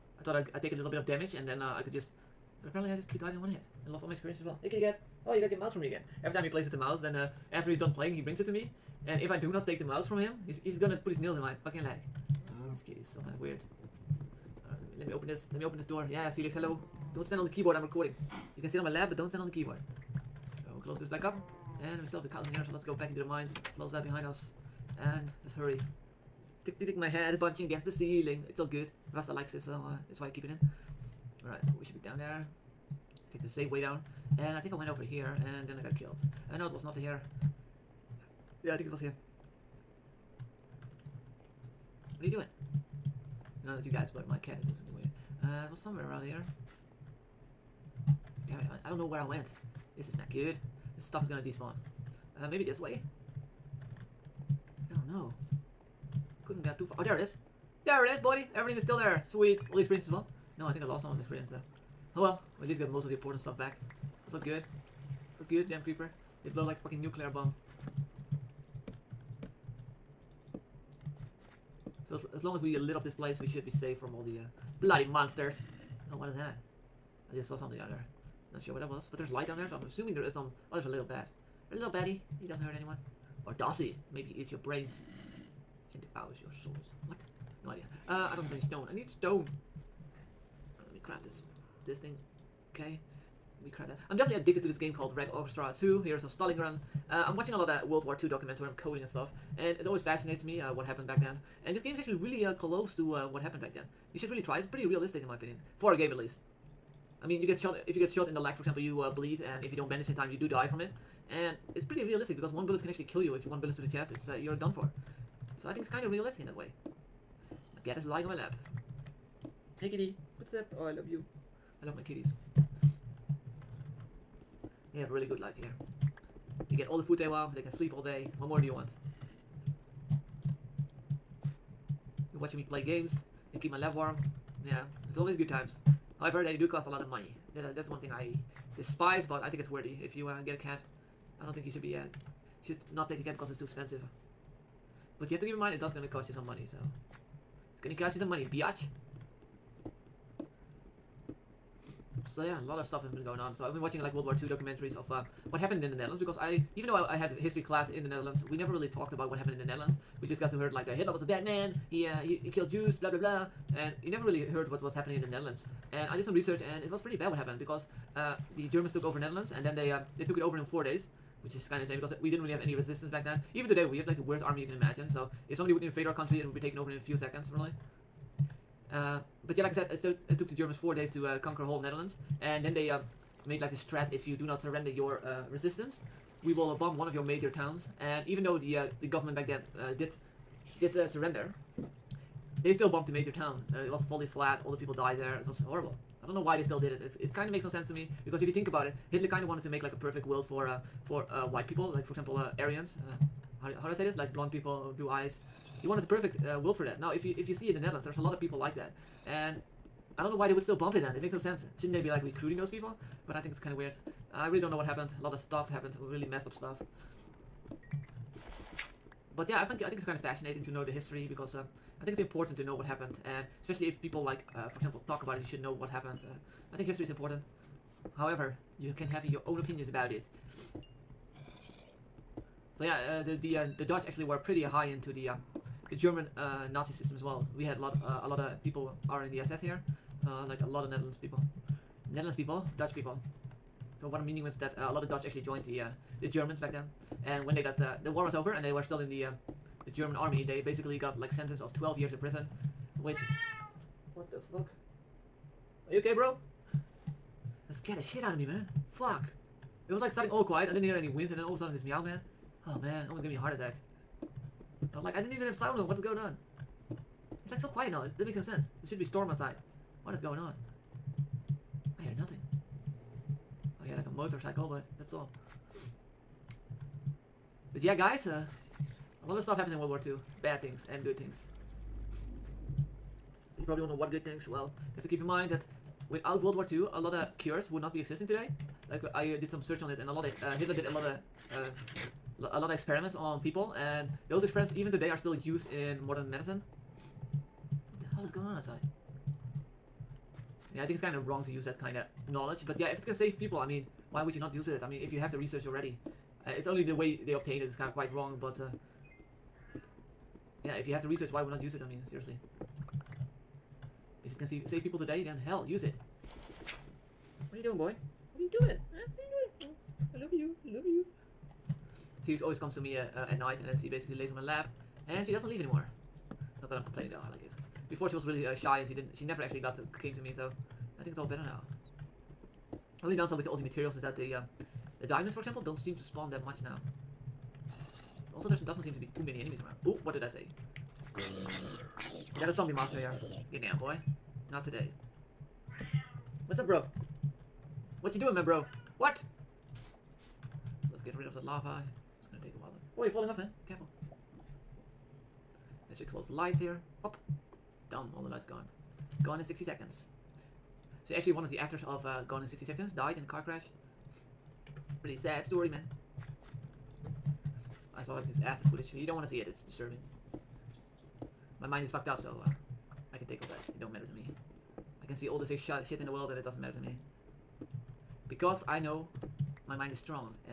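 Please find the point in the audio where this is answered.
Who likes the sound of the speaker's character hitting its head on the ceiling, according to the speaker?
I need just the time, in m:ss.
0:29.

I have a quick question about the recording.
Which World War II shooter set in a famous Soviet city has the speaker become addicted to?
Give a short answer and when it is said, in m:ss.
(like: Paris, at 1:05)
Red Orchestra 2, at 1:35.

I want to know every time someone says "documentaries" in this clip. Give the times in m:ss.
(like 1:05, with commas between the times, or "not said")
1:38, 2:34.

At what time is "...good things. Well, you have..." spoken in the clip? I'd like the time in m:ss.
4:44.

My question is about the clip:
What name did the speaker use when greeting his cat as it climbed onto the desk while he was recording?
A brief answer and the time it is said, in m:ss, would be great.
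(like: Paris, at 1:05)
Celix, at 0:16.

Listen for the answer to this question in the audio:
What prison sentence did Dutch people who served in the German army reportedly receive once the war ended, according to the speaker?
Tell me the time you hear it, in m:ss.
4:11.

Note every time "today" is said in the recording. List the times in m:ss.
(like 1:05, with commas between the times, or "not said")
2:53, 4:48, 4:54, 5:14, 5:44.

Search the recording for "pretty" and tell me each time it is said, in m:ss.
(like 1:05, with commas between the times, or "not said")
1:44, 1:51, 2:46, 3:54, 6:05.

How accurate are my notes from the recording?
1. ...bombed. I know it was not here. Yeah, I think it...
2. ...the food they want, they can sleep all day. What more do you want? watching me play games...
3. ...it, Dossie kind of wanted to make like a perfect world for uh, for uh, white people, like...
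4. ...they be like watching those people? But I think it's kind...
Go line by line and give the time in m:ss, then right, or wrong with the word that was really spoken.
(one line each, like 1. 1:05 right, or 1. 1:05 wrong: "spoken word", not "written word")
1. 0:35 wrong: "killed", not "bombed"
2. 2:06 right
3. 3:18 wrong: "Hitler", not "Dossie"
4. 3:31 wrong: "recruiting", not "watching".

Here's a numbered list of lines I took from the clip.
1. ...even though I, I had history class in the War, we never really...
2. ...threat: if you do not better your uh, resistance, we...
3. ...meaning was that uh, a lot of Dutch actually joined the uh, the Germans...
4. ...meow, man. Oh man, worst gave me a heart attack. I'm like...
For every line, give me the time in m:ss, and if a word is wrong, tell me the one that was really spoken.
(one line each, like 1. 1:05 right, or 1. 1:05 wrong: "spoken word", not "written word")
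1. 2:36 wrong: "Netherlands", not "War"
2. 3:03 wrong: "surrender", not "better"
3. 4:04 right
4. 4:21 wrong: "almost", not "worst".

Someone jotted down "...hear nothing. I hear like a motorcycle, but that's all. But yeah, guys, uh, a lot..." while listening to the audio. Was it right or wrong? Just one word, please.
right.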